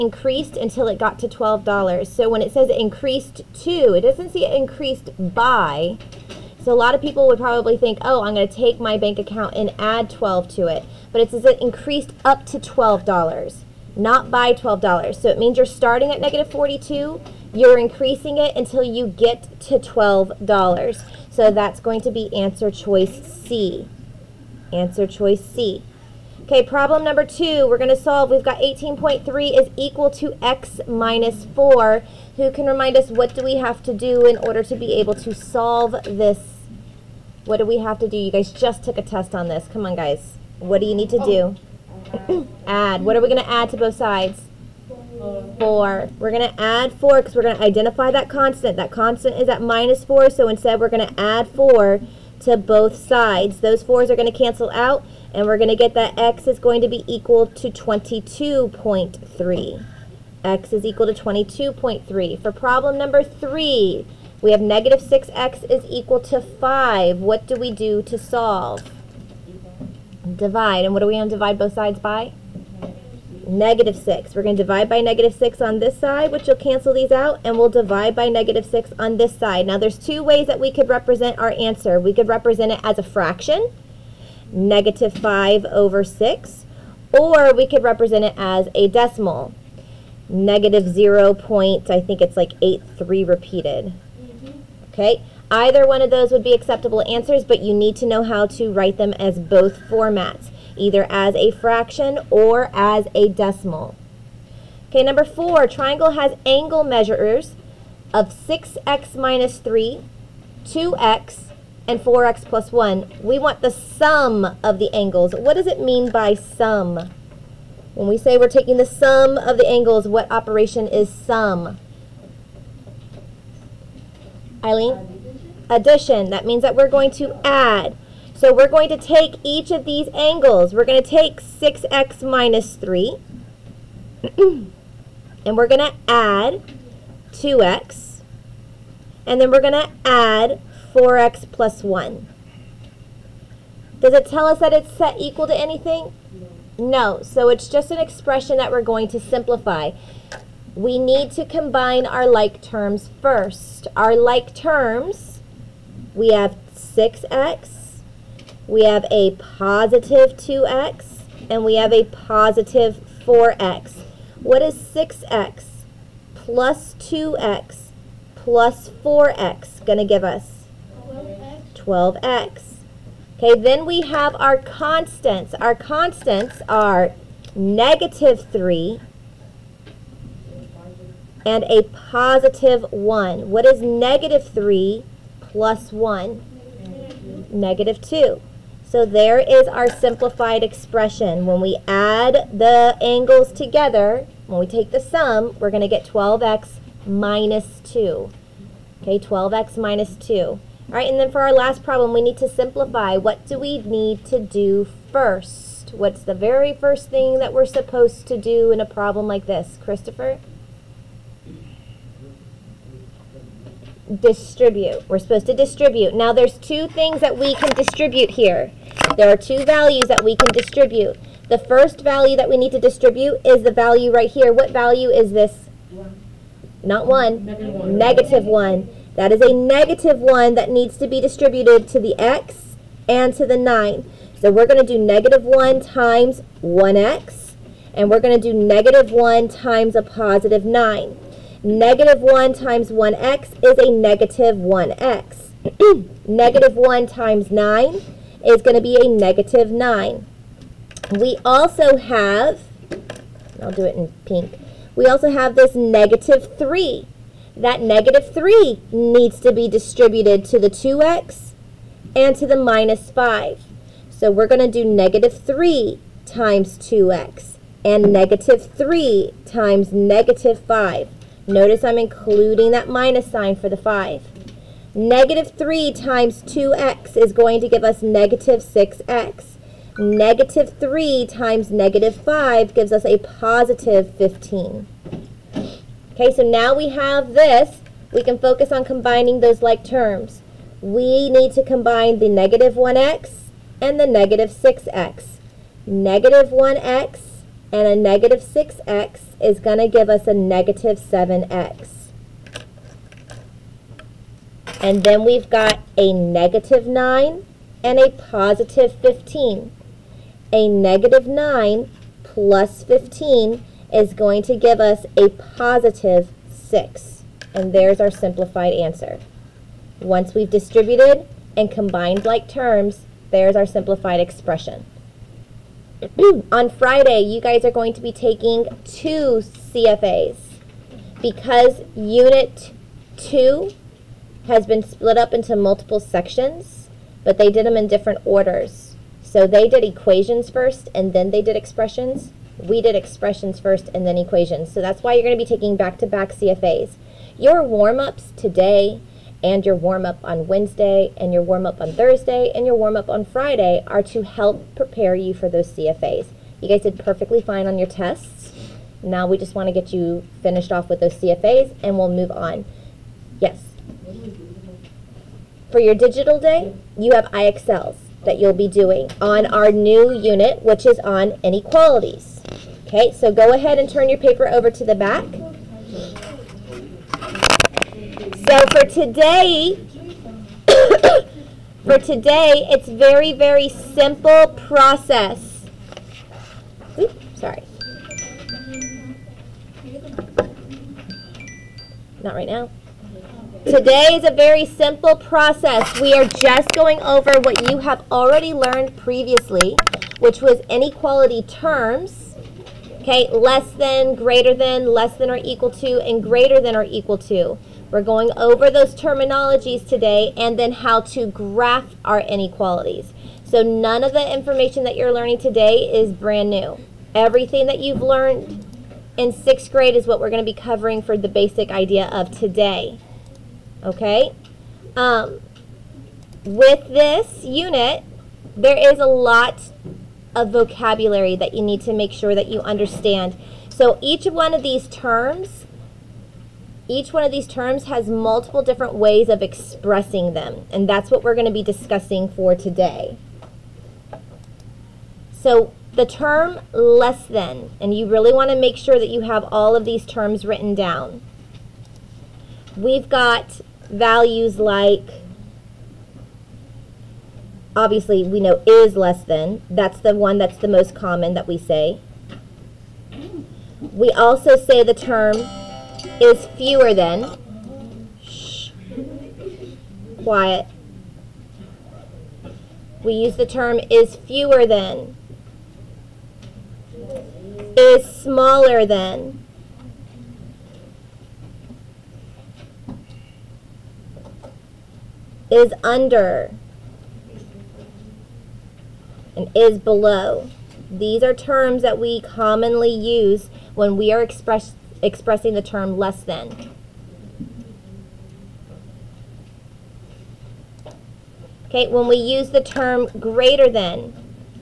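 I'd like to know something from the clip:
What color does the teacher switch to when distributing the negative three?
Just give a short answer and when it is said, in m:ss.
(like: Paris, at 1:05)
pink, at 4:14.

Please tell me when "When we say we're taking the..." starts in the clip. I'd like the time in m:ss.
1:57.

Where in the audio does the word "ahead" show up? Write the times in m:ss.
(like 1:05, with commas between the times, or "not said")
6:13.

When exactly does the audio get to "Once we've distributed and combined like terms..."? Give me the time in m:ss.
5:19.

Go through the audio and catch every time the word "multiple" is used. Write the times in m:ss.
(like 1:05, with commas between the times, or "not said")
5:35, 7:18.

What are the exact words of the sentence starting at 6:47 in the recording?
We're going over those terminologies today and then how to graph our inequalities.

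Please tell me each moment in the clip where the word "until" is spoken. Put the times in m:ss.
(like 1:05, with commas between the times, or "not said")
0:00, 0:18.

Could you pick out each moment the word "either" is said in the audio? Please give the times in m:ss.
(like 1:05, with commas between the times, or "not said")
1:35, 1:40.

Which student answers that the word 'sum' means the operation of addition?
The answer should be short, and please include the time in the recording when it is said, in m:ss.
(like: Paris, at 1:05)
Eileen, at 2:04.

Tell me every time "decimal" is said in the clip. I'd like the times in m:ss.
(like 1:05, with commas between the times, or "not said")
1:28, 1:43.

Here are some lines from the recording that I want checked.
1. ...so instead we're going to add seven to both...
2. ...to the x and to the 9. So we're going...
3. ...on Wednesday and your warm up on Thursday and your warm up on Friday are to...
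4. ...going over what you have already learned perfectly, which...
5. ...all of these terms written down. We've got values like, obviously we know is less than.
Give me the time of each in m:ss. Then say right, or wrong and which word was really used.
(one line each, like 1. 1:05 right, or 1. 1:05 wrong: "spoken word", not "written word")
1. 0:50 wrong: "four", not "seven"
2. 3:51 right
3. 5:50 right
4. 6:36 wrong: "previously", not "perfectly"
5. 7:29 right.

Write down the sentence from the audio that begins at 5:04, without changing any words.
And then we've got a negative 9 and a positive 15.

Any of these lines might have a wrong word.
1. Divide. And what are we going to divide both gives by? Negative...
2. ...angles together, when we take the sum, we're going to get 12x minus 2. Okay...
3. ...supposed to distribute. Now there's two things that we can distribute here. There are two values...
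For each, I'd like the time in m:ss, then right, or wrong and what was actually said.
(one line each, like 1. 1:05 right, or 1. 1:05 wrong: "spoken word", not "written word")
1. 1:10 wrong: "sides", not "gives"
2. 3:13 right
3. 3:35 right.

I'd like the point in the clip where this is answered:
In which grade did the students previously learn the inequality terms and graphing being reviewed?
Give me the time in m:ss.
6:59.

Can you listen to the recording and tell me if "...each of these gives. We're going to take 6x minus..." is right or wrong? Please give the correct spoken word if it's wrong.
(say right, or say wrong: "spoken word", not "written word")
wrong: "angles", not "gives".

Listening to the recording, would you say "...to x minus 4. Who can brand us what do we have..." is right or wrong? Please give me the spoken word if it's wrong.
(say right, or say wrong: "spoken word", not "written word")
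wrong: "remind", not "brand".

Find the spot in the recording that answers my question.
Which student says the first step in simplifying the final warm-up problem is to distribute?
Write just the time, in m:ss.
3:29.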